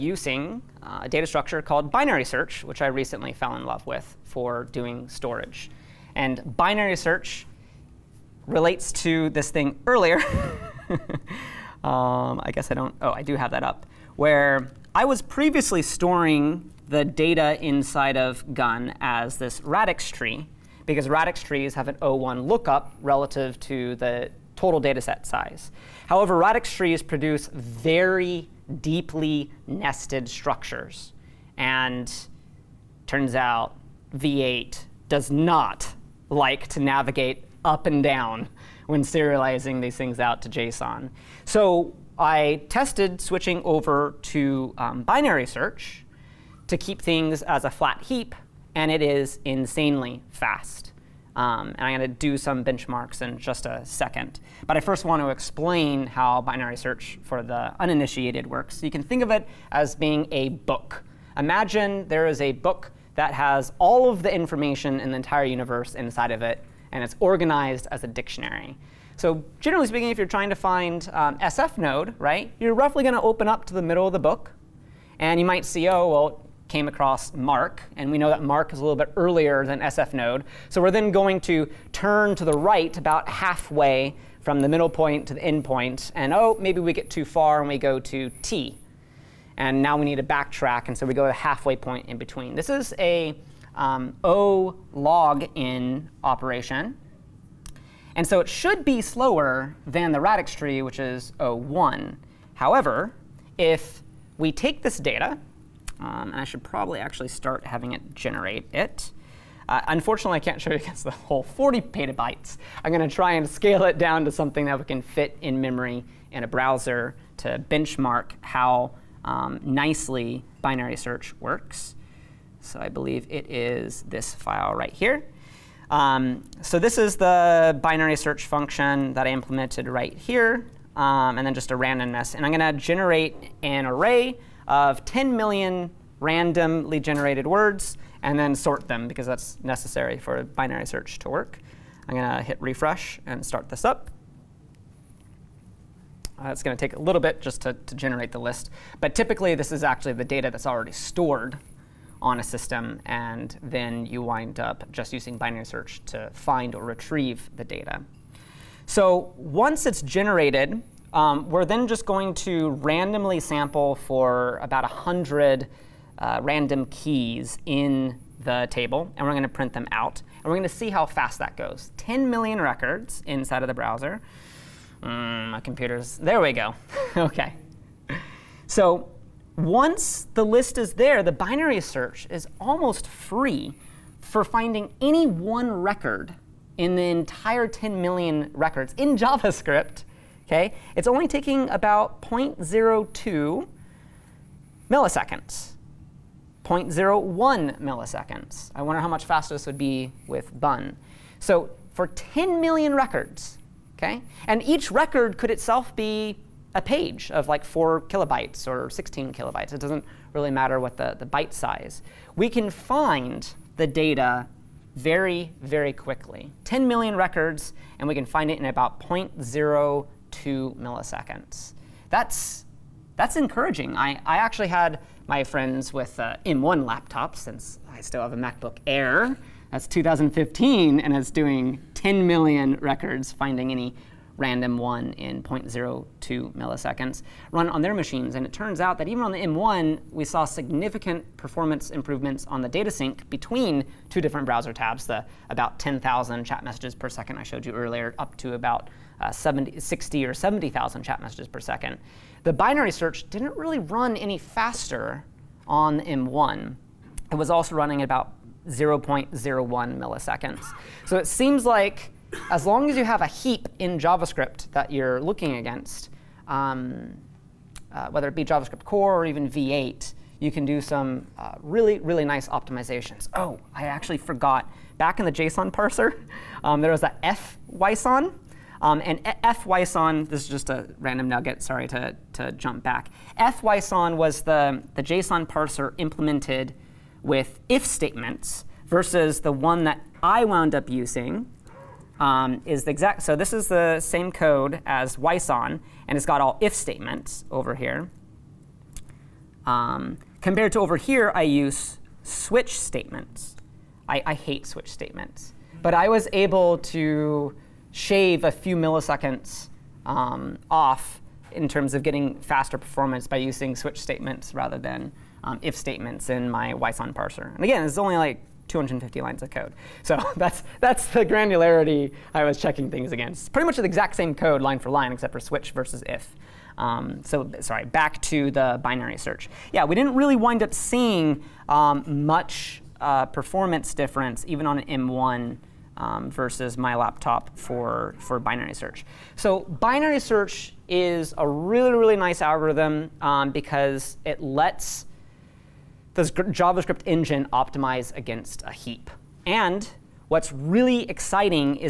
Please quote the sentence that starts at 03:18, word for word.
I wonder how much faster this would be with Bun.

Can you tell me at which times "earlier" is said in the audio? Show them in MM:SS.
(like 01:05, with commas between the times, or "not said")
00:09, 01:19, 04:07.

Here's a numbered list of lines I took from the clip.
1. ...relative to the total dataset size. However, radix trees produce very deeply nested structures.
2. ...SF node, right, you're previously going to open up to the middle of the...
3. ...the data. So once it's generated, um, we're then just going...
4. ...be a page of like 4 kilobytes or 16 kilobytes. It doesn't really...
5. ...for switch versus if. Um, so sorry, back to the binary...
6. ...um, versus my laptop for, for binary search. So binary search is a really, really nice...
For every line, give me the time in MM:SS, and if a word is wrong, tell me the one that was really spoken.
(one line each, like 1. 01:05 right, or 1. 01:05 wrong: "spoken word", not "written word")
1. 00:23 right
2. 01:11 wrong: "roughly", not "previously"
3. 02:37 right
4. 03:25 right
5. 05:25 right
6. 05:35 right.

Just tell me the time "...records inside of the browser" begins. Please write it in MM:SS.
02:52.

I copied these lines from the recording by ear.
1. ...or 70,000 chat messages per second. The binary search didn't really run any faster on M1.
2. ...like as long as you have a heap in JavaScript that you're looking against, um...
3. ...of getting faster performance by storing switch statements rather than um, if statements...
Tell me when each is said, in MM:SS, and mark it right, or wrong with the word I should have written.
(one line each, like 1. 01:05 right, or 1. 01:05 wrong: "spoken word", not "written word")
1. 04:10 right
2. 04:21 right
3. 05:11 wrong: "using", not "storing".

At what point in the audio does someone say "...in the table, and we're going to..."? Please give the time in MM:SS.
02:47.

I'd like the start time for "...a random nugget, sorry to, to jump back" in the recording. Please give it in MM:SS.
04:40.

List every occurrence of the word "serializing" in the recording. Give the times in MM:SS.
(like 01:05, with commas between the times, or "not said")
00:39.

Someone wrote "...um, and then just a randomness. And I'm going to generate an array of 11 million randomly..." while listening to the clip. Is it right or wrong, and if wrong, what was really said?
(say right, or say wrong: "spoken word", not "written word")
wrong: "10", not "11".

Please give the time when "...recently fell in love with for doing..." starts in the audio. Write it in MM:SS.
00:02.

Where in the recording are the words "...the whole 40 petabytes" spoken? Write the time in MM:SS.
01:51.